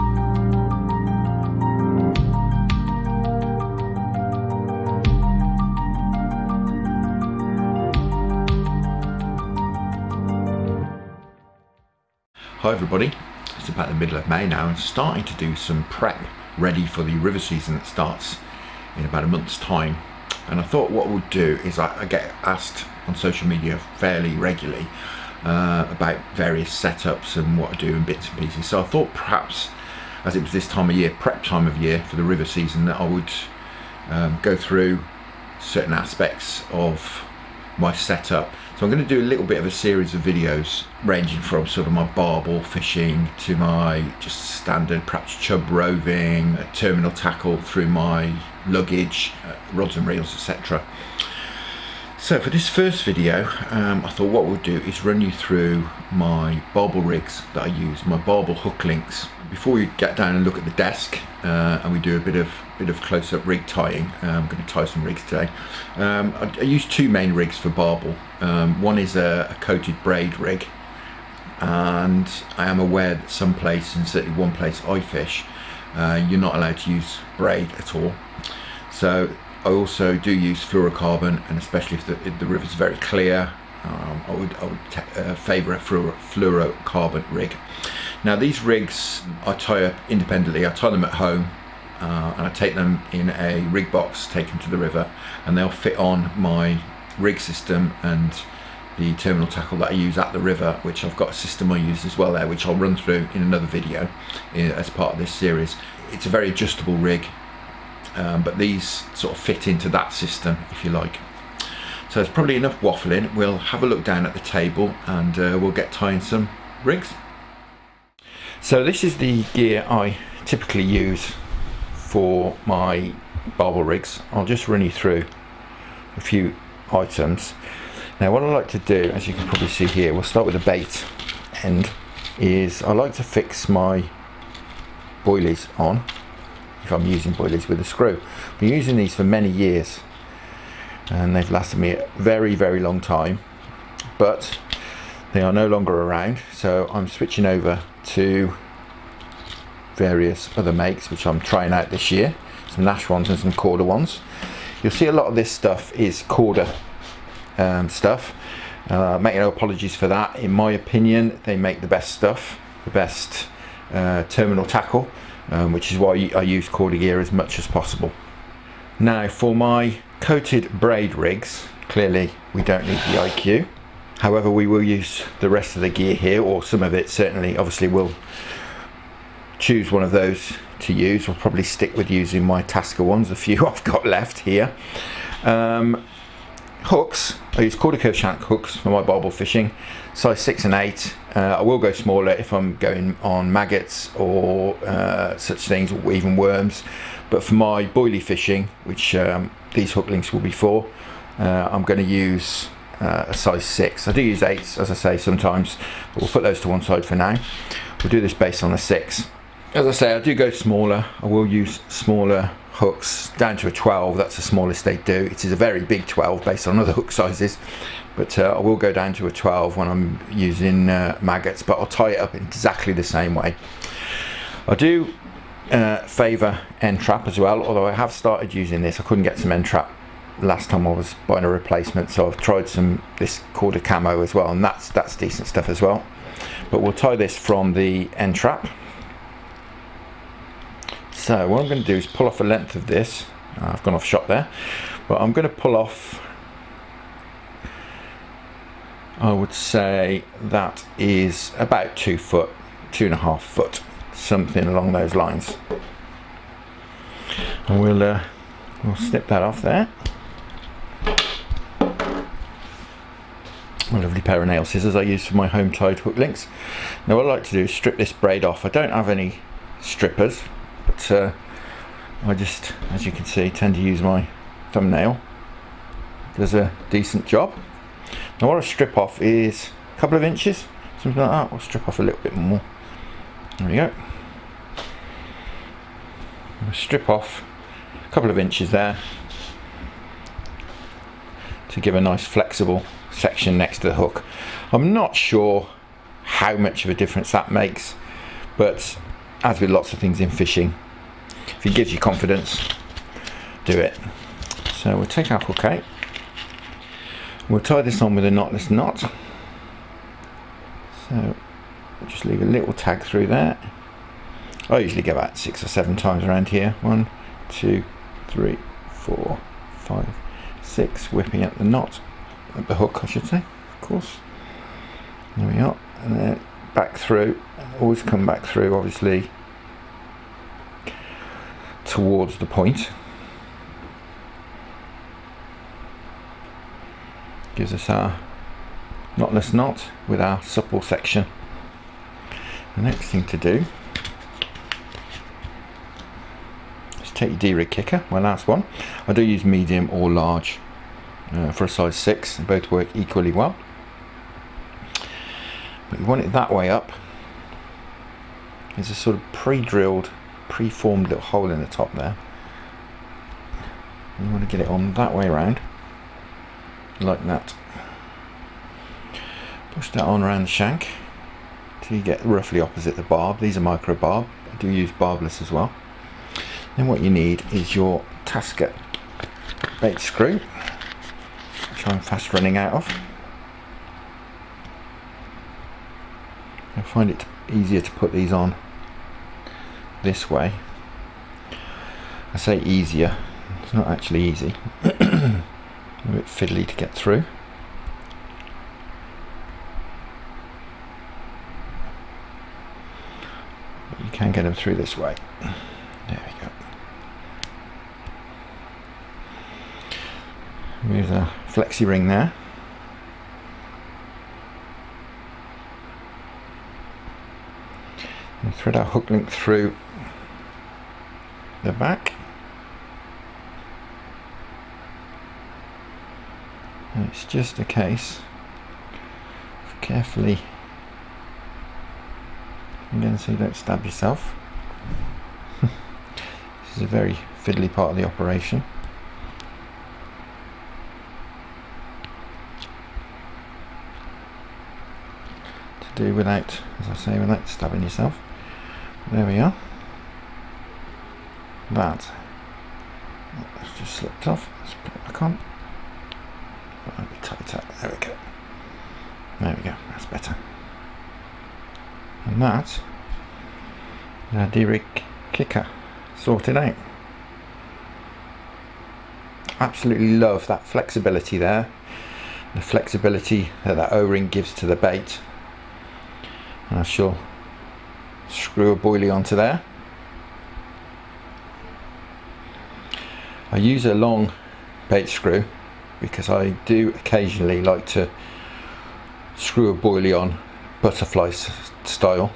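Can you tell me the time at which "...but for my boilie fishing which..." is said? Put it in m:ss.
3:17.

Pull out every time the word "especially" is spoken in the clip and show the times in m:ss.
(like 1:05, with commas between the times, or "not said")
1:21.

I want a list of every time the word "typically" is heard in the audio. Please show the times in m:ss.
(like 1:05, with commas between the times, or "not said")
2:00.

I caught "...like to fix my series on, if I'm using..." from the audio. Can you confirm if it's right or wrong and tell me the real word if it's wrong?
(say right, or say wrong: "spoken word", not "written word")
wrong: "boilies", not "series".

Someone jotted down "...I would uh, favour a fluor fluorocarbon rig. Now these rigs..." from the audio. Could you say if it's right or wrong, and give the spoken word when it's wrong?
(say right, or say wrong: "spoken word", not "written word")
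right.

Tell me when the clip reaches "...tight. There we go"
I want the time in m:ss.
7:37.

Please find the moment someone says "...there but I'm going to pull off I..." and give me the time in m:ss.
4:04.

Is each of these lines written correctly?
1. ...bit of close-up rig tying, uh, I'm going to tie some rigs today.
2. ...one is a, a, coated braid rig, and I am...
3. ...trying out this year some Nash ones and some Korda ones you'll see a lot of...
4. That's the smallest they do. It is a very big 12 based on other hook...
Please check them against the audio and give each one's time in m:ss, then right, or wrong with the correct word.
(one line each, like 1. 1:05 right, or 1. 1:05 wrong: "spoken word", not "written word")
1. 1:02 right
2. 1:08 right
3. 2:31 right
4. 3:34 right.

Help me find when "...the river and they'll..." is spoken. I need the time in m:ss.
1:34.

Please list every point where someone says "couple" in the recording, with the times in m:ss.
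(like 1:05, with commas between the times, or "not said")
4:39, 4:48.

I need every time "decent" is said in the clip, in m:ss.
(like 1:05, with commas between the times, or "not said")
3:55, 4:36.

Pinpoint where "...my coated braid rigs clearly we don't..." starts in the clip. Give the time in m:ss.
2:49.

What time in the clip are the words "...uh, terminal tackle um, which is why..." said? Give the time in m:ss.
2:43.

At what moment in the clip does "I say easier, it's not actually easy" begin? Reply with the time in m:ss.
6:32.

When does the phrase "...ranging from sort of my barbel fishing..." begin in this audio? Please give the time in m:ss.
0:41.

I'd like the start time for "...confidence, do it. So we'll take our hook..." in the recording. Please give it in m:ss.
5:01.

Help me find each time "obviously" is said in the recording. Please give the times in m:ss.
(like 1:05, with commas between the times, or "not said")
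2:57, 5:28.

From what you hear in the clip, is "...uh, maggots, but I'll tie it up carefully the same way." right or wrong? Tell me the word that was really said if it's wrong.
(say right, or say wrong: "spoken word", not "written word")
wrong: "exactly", not "carefully".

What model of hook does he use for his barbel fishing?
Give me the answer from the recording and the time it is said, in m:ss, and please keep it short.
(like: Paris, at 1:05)
Korda Kurv shank, at 3:07.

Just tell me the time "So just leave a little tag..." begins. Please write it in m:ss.
5:11.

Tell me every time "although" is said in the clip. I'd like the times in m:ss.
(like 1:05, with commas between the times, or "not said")
3:47.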